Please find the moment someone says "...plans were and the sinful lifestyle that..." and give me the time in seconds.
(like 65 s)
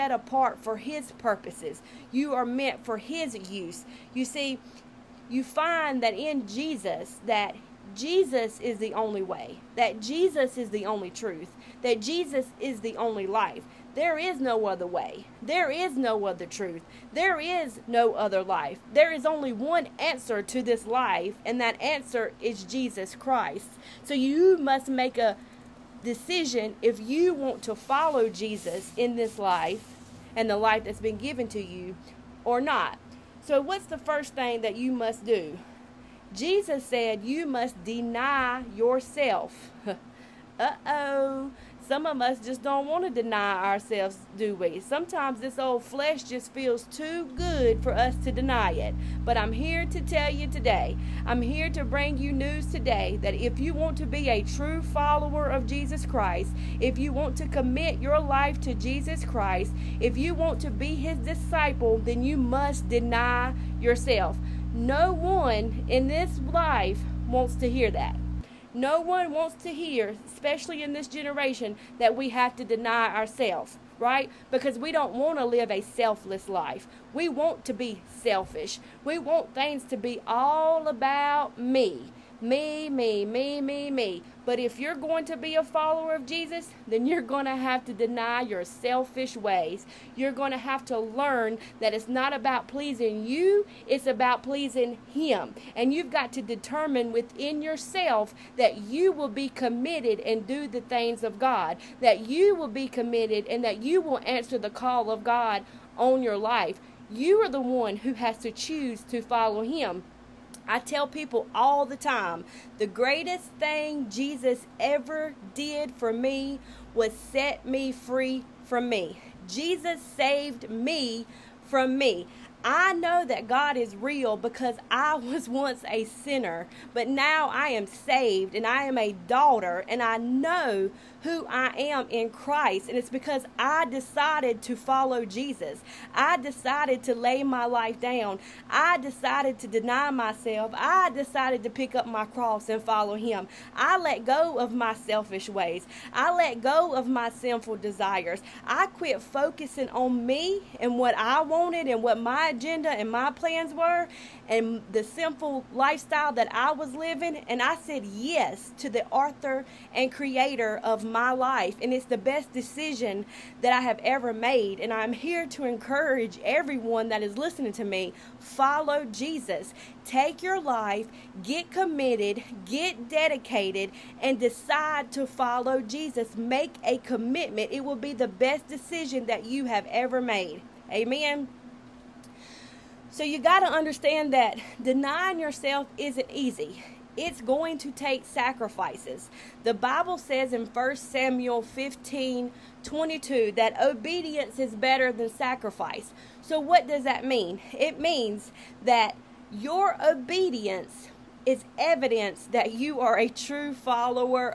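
153 s.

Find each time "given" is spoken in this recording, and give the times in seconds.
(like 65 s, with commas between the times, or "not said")
31 s.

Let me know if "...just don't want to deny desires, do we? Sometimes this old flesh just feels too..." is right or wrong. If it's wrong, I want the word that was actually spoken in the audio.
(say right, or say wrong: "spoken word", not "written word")
wrong: "ourselves", not "desires".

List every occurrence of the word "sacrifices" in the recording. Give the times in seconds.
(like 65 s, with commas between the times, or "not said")
188 s, 195 s.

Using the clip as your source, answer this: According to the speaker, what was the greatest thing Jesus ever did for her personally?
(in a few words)
Set me free from me.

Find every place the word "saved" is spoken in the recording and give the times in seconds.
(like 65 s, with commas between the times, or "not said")
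119 s, 127 s.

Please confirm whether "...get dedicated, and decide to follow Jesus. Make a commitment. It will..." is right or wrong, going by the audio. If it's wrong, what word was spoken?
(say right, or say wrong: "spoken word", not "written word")
right.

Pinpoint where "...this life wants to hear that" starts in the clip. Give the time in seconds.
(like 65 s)
66 s.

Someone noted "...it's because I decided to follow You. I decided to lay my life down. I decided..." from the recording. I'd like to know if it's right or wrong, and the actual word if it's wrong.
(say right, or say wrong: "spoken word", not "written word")
wrong: "Jesus", not "You".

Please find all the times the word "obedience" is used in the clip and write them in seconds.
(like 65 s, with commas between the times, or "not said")
193 s, 200 s.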